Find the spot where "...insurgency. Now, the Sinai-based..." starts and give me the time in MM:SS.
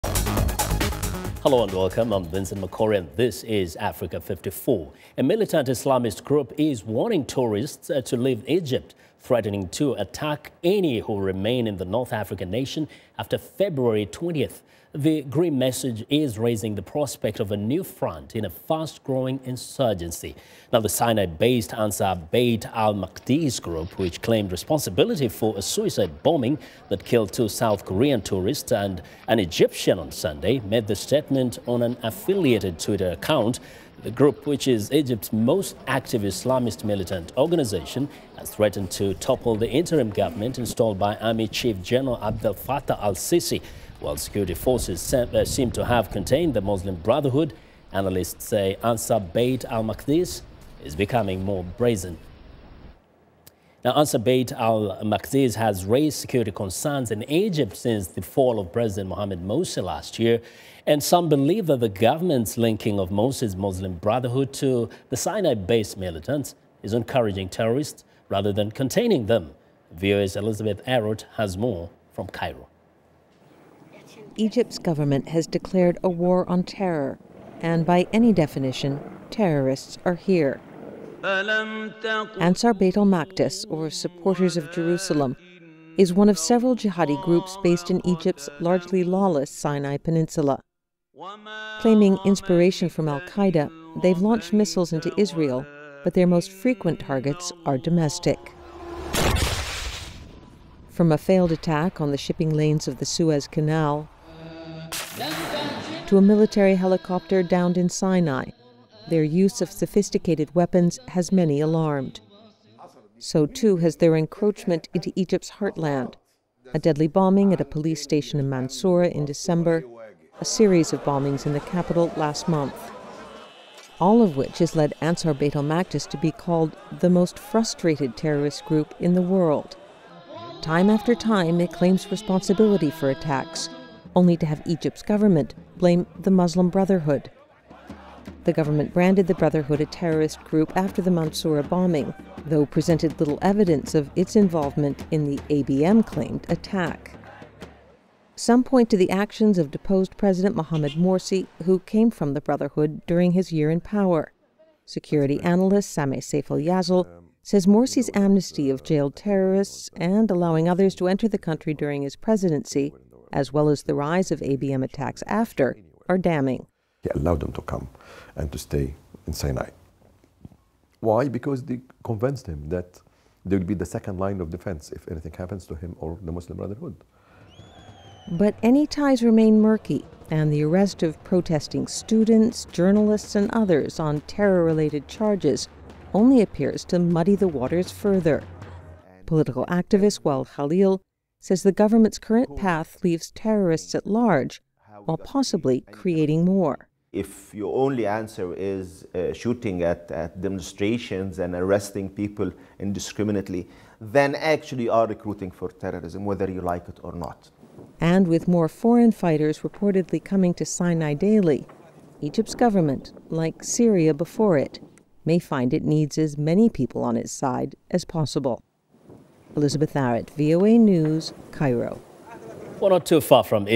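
00:19.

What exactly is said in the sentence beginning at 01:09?
VOA's Elizabeth Arrott has more from Cairo.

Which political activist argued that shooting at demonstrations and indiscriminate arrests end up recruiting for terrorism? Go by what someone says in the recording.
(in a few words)
Wael Khalil.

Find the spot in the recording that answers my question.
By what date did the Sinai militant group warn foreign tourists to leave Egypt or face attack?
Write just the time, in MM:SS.
00:13.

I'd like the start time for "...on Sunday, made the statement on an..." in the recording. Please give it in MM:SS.
00:29.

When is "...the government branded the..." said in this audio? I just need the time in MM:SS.
02:18.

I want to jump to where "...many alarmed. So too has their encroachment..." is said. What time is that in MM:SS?
01:51.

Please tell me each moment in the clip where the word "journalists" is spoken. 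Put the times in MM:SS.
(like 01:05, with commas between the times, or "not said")
03:02.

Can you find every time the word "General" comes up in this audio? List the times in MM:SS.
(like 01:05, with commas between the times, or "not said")
00:41.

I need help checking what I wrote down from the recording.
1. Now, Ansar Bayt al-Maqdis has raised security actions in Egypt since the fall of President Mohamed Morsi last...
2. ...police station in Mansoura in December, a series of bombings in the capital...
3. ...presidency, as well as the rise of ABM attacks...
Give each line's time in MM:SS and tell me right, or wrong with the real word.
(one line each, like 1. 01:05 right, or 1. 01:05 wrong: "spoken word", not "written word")
1. 00:53 wrong: "concerns", not "actions"
2. 01:57 right
3. 02:42 right.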